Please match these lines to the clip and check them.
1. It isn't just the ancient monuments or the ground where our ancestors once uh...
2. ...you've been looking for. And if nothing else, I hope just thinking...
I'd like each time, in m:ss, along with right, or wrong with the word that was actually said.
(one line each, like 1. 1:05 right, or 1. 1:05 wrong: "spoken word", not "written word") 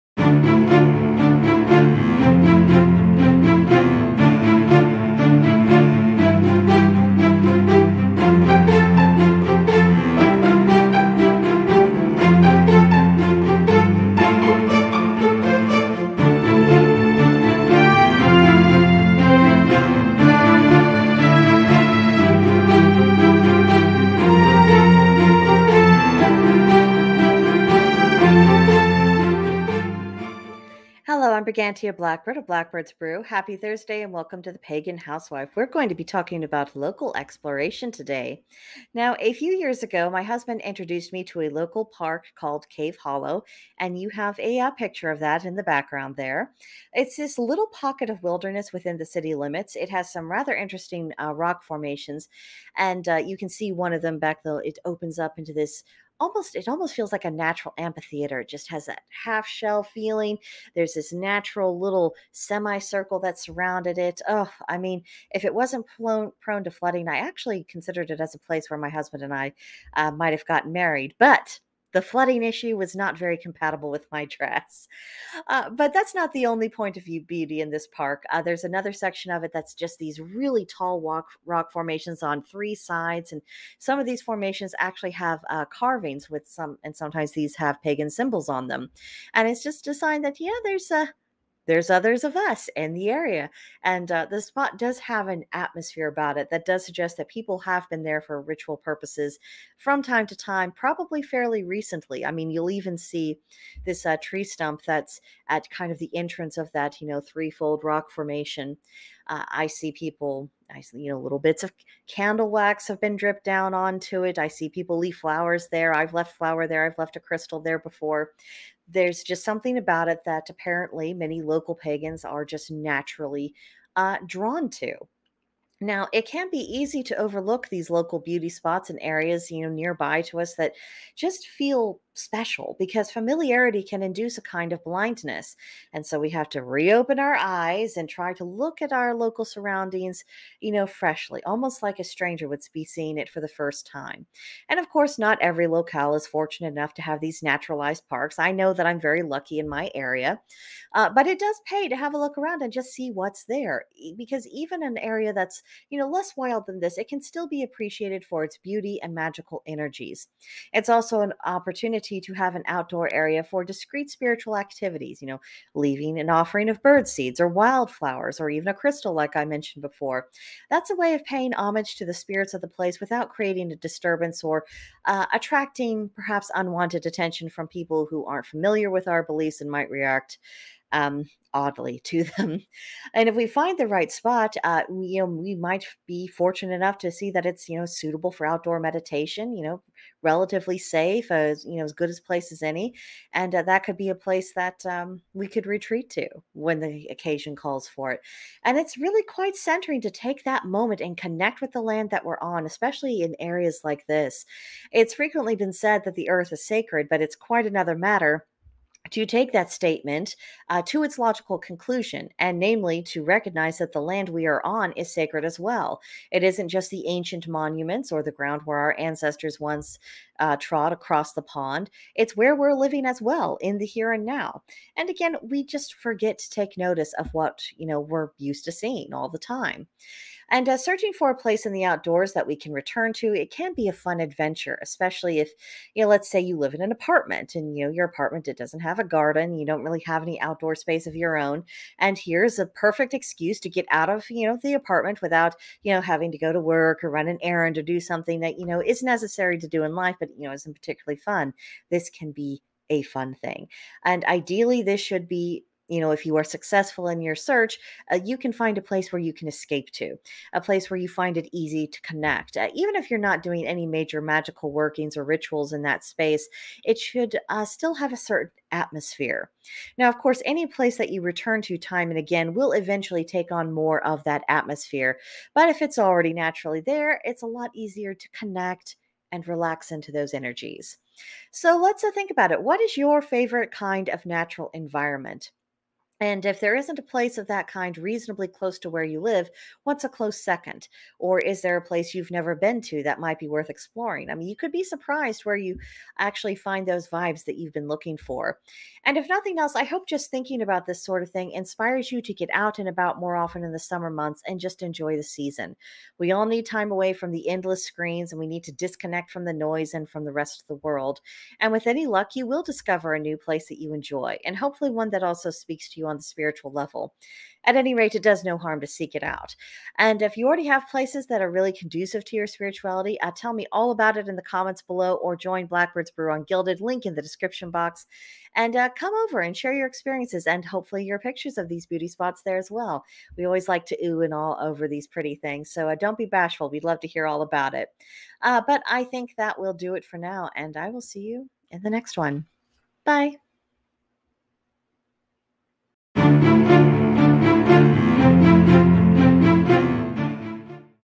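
1. 3:36 right
2. 4:57 right.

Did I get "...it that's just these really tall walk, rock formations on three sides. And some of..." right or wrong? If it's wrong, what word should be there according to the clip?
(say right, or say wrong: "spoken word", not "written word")
right.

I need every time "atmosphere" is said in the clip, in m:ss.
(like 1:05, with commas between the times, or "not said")
1:35, 4:28, 4:34.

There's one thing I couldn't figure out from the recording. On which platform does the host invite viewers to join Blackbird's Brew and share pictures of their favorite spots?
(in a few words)
Guilded.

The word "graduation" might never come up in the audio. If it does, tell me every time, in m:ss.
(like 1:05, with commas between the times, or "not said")
not said.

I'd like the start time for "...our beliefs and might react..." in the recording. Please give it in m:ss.
2:59.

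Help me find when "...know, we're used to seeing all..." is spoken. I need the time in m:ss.
3:47.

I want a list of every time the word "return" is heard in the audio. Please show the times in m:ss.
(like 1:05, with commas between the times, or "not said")
3:52, 4:31.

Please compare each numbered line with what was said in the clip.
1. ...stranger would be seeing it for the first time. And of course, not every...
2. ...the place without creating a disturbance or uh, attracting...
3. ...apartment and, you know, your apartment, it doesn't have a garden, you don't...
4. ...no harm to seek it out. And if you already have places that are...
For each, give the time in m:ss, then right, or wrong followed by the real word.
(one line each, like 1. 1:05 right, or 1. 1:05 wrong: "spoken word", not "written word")
1. 2:22 right
2. 2:52 right
3. 3:56 right
4. 5:18 right.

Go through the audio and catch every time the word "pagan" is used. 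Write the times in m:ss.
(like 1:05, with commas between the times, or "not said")
0:34, 1:27, 2:01.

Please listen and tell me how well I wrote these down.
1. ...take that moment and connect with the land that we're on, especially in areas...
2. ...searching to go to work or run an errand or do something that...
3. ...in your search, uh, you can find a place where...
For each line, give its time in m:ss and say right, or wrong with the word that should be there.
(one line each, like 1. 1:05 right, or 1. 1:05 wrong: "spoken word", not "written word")
1. 3:20 right
2. 4:06 wrong: "having", not "searching"
3. 4:17 right.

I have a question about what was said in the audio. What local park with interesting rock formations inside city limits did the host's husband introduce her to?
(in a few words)
Cave Hollow.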